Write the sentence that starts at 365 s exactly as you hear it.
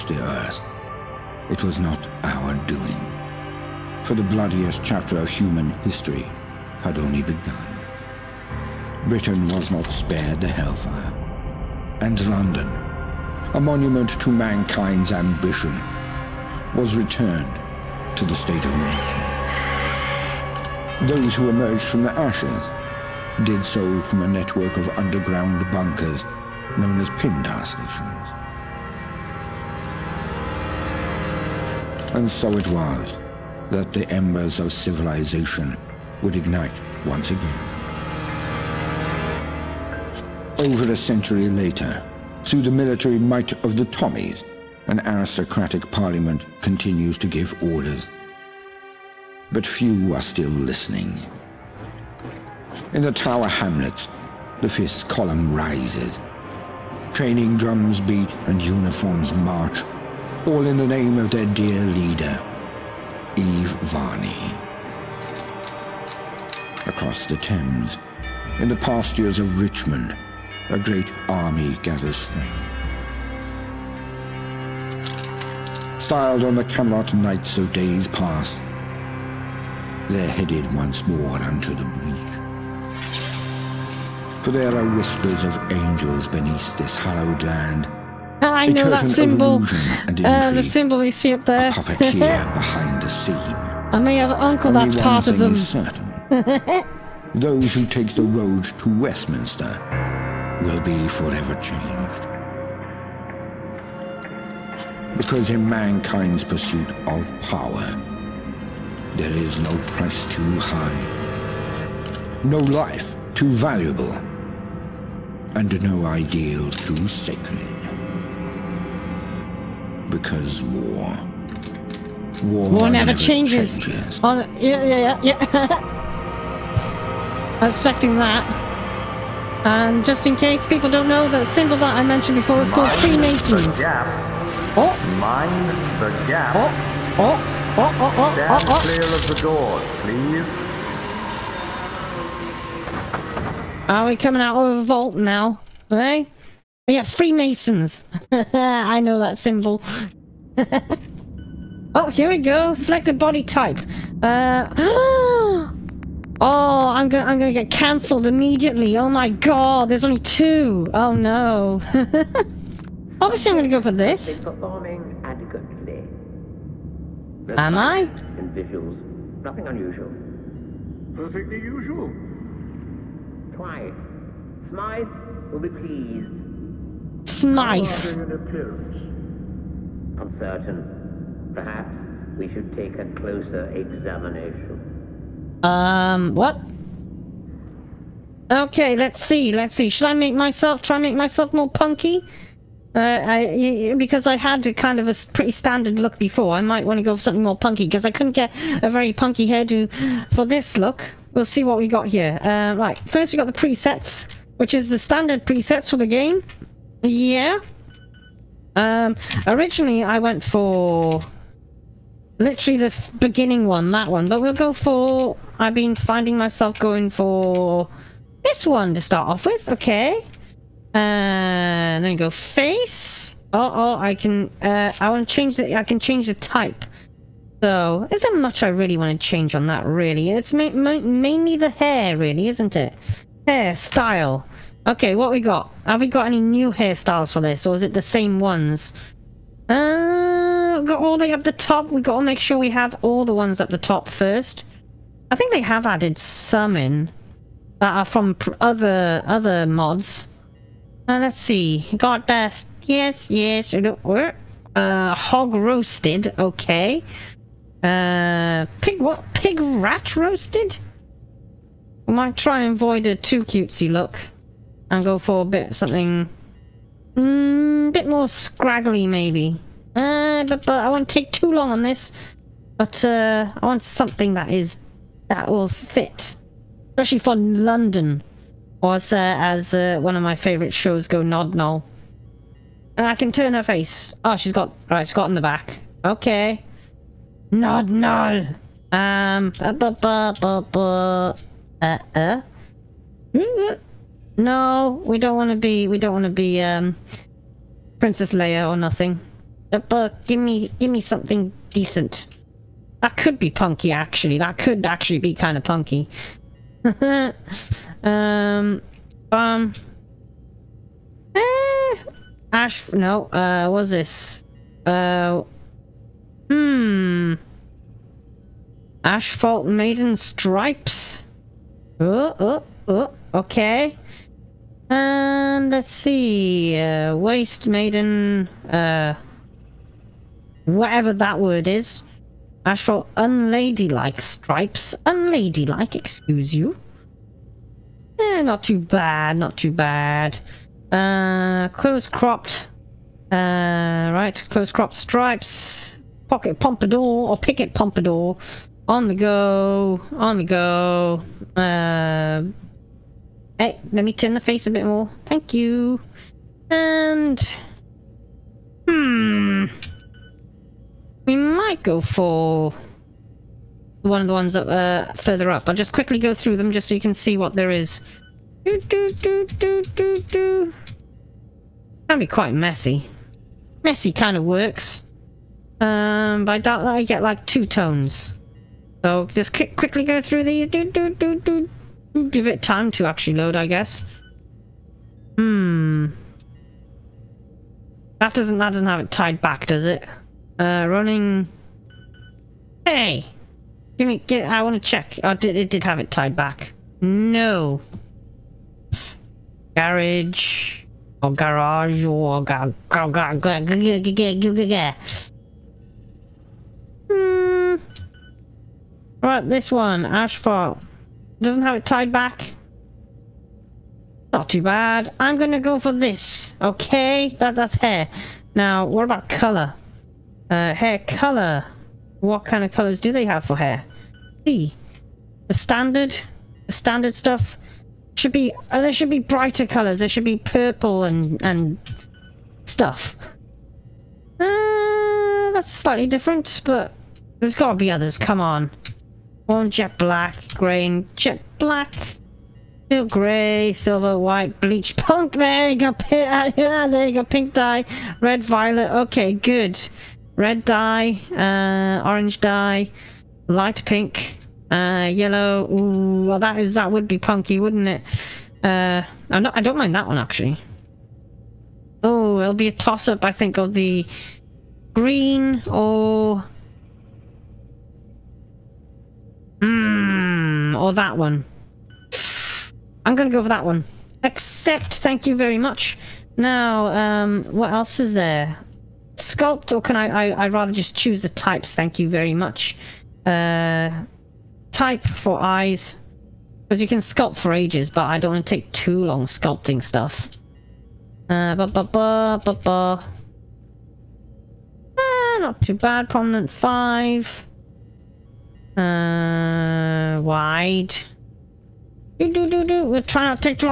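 I'll just quickly go through them just so you can see what there is.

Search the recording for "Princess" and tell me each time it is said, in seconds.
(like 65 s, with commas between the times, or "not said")
297 s.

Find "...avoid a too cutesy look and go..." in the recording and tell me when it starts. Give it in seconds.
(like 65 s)
262 s.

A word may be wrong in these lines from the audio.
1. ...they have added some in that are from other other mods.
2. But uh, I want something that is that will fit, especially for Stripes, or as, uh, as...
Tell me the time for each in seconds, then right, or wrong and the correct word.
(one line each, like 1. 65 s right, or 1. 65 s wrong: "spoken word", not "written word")
1. 245 s right
2. 272 s wrong: "London", not "Stripes".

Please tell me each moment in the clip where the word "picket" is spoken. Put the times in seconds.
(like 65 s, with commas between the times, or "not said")
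347 s.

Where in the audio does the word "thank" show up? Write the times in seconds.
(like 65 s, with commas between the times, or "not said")
355 s, 474 s, 481 s.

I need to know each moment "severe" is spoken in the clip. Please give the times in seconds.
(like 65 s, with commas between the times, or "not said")
not said.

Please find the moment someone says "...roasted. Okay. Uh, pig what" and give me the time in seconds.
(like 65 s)
255 s.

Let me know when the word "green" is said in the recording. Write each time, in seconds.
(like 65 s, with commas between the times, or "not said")
440 s, 464 s.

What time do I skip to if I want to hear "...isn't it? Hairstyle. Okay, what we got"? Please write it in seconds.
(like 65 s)
232 s.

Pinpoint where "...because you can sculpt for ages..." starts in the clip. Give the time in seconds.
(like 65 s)
486 s.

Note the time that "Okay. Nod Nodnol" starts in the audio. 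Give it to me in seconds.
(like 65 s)
286 s.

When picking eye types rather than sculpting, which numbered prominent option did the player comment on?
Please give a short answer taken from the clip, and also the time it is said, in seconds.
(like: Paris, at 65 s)
Prominent 5, at 496 s.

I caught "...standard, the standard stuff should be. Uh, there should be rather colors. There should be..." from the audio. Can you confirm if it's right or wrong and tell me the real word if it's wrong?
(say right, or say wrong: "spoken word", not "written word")
wrong: "brighter", not "rather".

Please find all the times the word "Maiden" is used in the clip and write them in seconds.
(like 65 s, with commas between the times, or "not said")
319 s, 327 s.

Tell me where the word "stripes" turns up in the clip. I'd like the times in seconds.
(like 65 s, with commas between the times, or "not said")
320 s, 334 s, 344 s.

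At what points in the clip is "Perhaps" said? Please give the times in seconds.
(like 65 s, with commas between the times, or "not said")
181 s.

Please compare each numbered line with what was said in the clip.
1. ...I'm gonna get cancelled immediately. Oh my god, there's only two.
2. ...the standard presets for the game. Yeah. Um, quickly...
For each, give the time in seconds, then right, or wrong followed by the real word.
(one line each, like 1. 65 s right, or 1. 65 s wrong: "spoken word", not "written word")
1. 157 s right
2. 204 s wrong: "originally", not "quickly".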